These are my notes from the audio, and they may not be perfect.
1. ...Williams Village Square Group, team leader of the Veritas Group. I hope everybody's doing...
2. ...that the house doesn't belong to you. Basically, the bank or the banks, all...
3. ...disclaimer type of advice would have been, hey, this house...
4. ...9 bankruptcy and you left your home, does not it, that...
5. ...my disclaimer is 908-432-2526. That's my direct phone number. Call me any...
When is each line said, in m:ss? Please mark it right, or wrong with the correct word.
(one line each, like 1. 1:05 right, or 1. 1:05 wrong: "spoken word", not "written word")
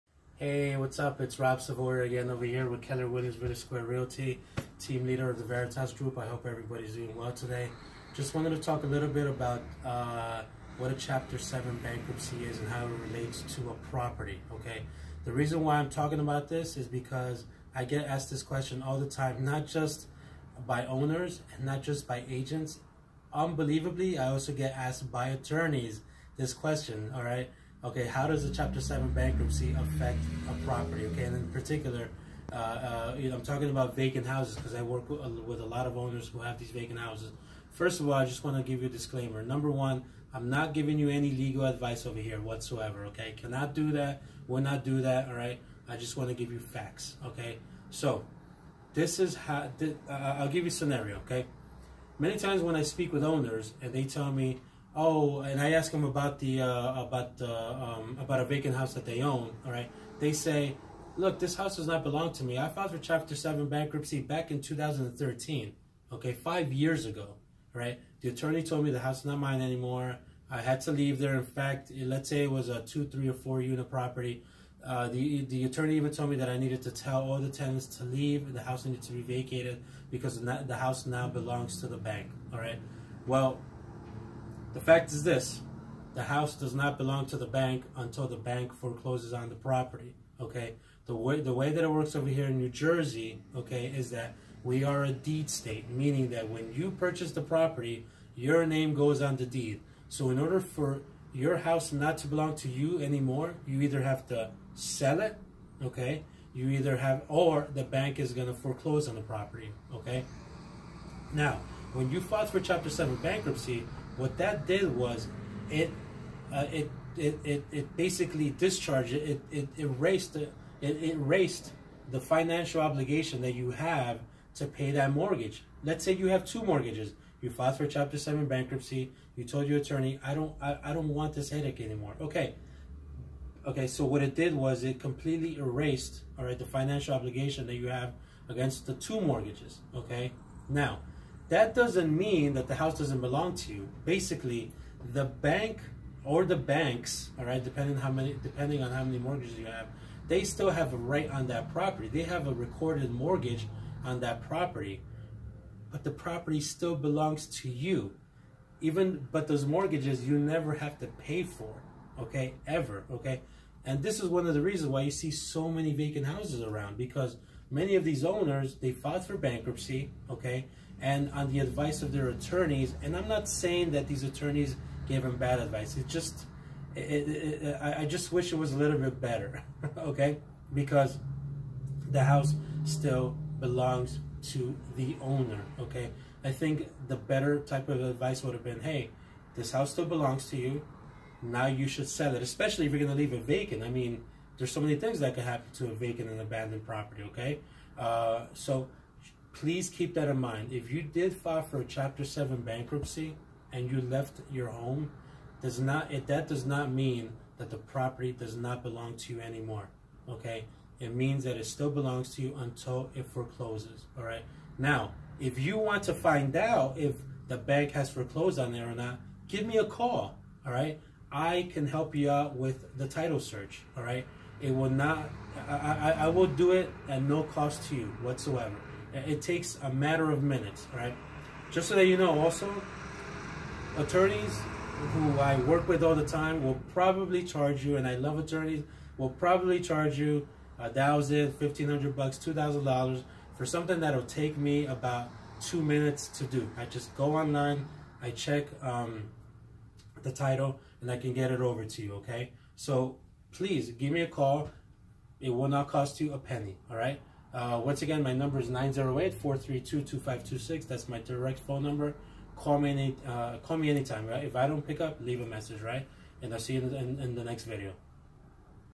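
1. 0:03 wrong: "Realty", not "Group"
2. 2:22 right
3. 3:07 wrong: "better", not "disclaimer"
4. 3:22 wrong: "7", not "9"
5. 4:18 wrong: "number", not "disclaimer".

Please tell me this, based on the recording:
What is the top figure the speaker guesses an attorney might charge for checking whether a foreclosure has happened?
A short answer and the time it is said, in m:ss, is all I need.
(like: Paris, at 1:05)
$2,000, at 4:02.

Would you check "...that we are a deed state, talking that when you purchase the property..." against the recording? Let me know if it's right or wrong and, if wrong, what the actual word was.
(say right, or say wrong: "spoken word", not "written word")
wrong: "meaning", not "talking".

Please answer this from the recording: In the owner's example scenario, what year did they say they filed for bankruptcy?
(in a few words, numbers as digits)
2013.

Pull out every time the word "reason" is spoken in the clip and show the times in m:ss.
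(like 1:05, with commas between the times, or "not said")
0:15, 2:44.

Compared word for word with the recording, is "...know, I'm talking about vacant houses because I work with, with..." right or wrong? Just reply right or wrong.
right.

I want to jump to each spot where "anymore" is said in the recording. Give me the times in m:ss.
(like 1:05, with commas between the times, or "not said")
1:09, 1:43, 2:11, 3:29.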